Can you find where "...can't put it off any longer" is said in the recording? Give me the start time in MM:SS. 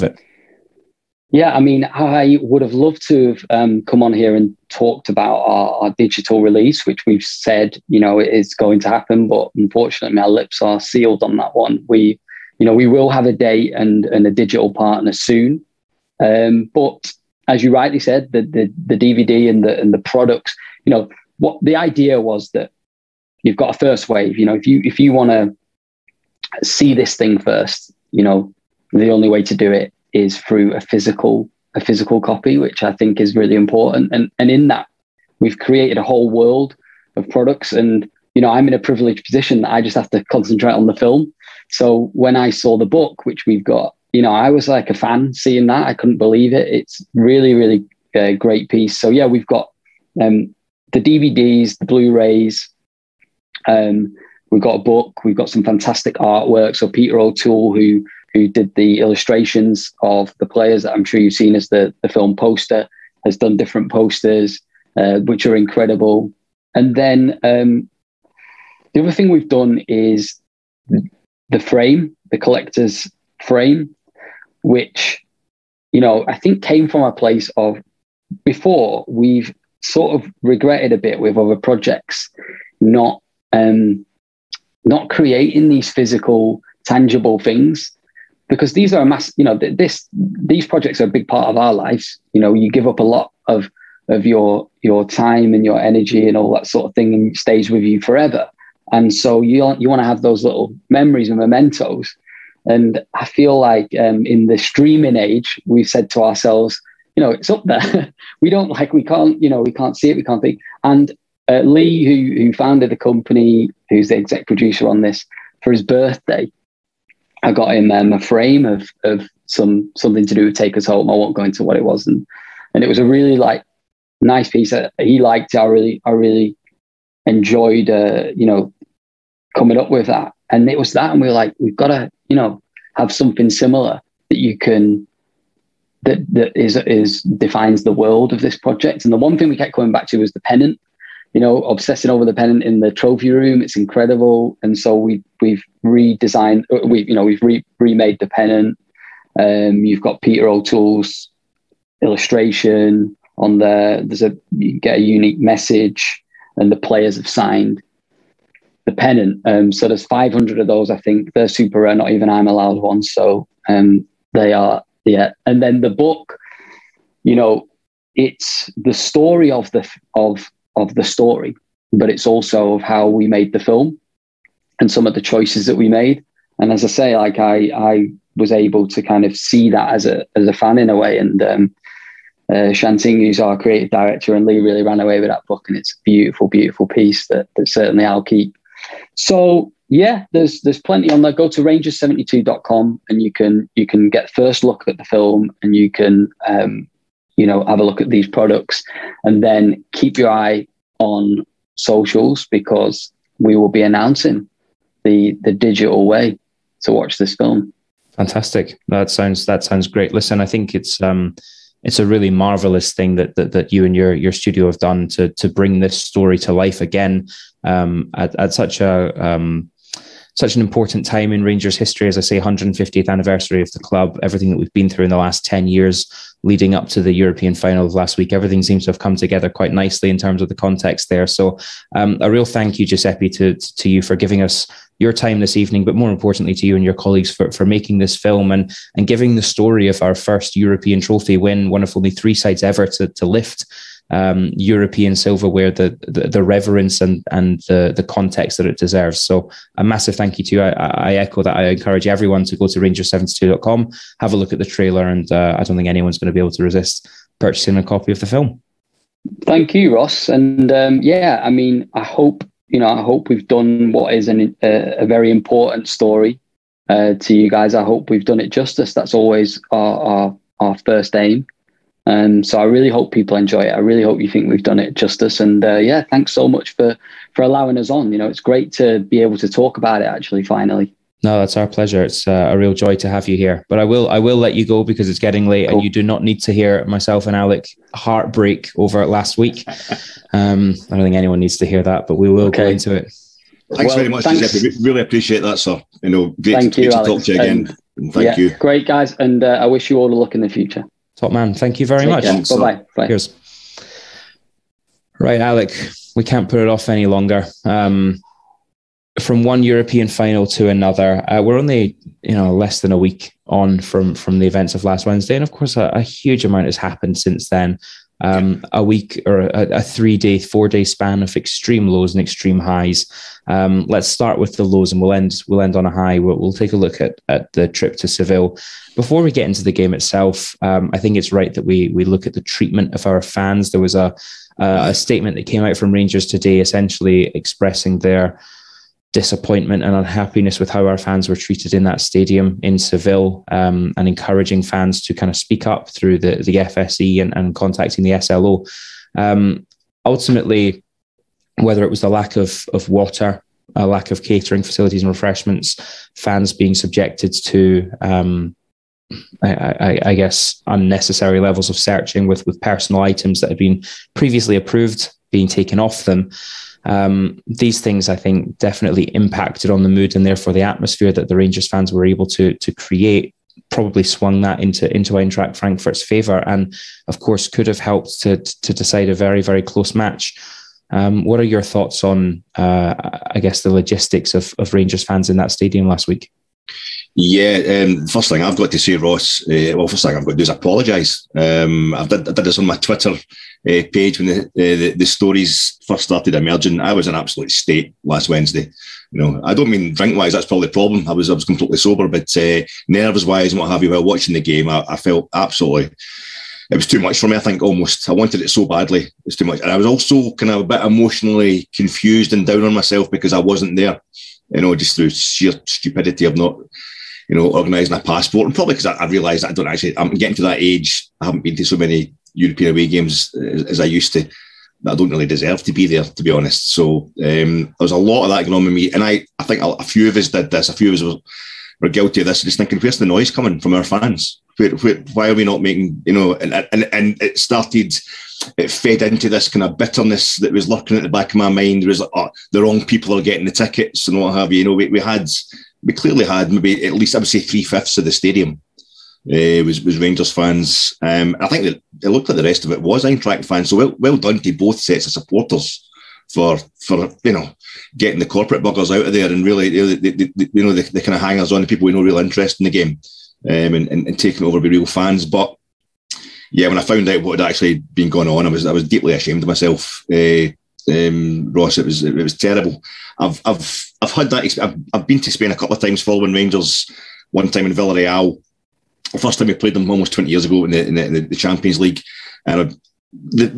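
05:06.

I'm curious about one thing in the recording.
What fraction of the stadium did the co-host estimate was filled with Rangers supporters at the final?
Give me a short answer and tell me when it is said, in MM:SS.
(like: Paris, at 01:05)
Three fifths, at 07:27.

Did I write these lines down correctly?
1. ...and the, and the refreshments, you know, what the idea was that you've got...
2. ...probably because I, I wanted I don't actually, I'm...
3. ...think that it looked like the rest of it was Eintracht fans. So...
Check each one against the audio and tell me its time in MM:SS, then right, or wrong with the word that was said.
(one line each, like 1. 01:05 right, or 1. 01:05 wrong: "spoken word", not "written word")
1. 00:19 wrong: "products", not "refreshments"
2. 06:58 wrong: "realised", not "wanted"
3. 07:31 right.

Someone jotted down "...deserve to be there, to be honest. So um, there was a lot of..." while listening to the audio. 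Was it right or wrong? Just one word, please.
right.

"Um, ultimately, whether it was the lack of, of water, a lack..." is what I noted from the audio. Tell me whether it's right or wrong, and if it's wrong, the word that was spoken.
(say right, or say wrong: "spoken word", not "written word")
right.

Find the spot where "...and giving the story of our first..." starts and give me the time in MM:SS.
03:58.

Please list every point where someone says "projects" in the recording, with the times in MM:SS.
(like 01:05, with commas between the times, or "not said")
01:21, 01:30, 02:18.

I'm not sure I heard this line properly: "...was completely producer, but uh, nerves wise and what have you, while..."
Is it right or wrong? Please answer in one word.
wrong.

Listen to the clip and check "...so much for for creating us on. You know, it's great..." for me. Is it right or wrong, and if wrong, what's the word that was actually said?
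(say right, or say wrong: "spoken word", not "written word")
wrong: "allowing", not "creating".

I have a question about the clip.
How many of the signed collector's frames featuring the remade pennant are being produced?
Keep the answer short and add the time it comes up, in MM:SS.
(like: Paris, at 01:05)
500, at 02:40.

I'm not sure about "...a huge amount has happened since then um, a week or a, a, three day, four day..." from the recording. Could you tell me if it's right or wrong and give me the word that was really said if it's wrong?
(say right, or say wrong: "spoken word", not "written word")
right.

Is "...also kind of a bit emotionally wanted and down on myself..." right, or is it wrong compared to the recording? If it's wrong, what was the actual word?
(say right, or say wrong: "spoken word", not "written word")
wrong: "confused", not "wanted".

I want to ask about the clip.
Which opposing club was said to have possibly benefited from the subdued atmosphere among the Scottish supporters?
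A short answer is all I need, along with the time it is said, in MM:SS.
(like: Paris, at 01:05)
Eintracht Frankfurt, at 06:15.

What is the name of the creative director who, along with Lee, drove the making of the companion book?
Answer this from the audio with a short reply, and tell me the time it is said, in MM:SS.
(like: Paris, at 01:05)
Shanting, at 03:02.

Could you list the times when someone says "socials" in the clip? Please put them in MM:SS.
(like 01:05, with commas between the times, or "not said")
03:21.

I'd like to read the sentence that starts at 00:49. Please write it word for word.
So yeah, we've got um, the DVDs, the Blu-rays.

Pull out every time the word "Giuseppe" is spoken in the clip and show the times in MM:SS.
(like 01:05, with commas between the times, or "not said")
03:52, 04:54.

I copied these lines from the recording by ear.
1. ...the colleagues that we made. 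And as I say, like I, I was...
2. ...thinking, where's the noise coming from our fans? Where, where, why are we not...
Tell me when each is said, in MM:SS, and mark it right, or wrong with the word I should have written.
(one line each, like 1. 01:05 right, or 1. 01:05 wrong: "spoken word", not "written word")
1. 02:55 wrong: "choices", not "colleagues"
2. 07:12 right.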